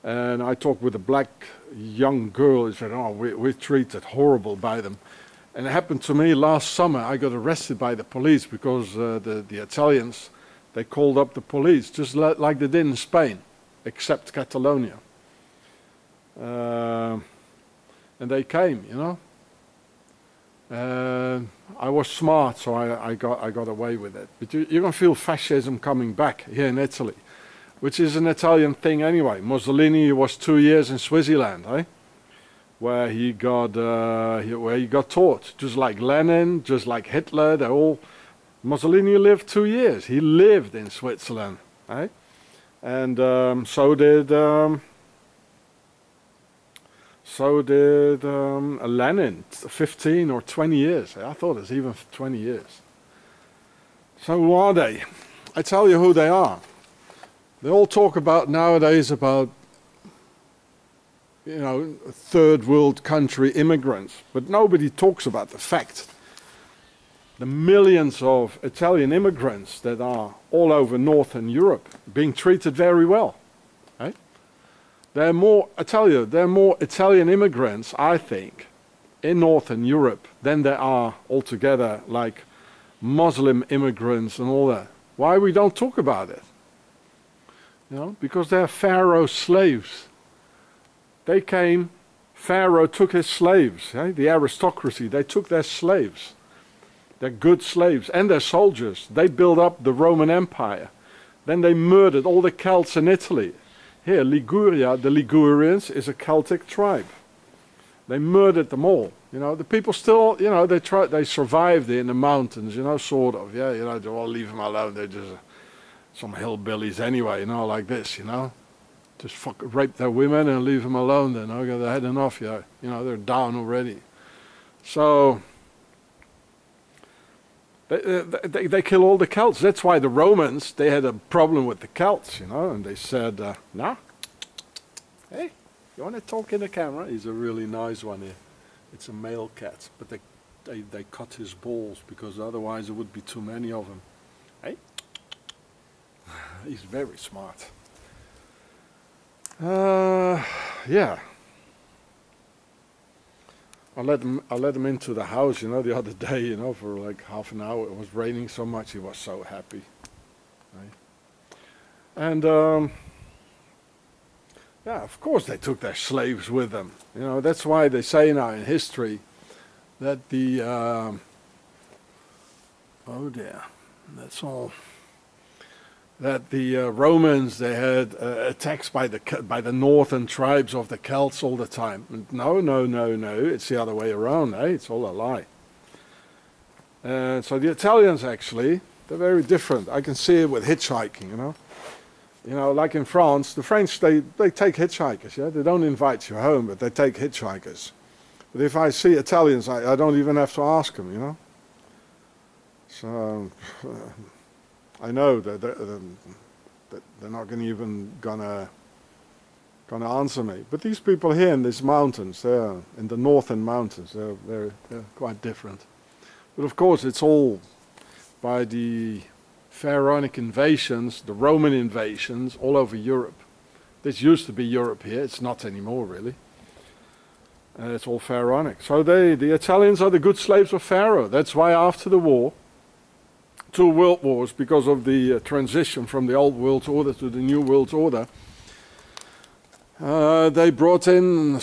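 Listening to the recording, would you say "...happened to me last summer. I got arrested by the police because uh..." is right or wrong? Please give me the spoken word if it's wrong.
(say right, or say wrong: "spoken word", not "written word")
right.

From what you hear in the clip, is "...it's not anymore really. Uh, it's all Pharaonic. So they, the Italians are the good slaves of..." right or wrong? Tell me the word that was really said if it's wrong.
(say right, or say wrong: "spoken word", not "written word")
right.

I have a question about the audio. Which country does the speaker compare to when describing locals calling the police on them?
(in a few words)
Spain.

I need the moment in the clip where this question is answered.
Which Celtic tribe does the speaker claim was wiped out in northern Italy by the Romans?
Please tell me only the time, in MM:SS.
01:45.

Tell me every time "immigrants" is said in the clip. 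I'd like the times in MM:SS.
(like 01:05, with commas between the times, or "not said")
01:03, 01:09, 01:17, 01:23.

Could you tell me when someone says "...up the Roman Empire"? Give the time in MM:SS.
01:39.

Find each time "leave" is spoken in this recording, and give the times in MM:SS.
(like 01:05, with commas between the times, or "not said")
01:54, 02:00.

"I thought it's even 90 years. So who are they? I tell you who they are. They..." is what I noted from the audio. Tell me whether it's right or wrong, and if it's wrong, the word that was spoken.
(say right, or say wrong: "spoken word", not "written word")
wrong: "20", not "90".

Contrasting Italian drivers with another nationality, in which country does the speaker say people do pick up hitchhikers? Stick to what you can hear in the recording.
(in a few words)
France.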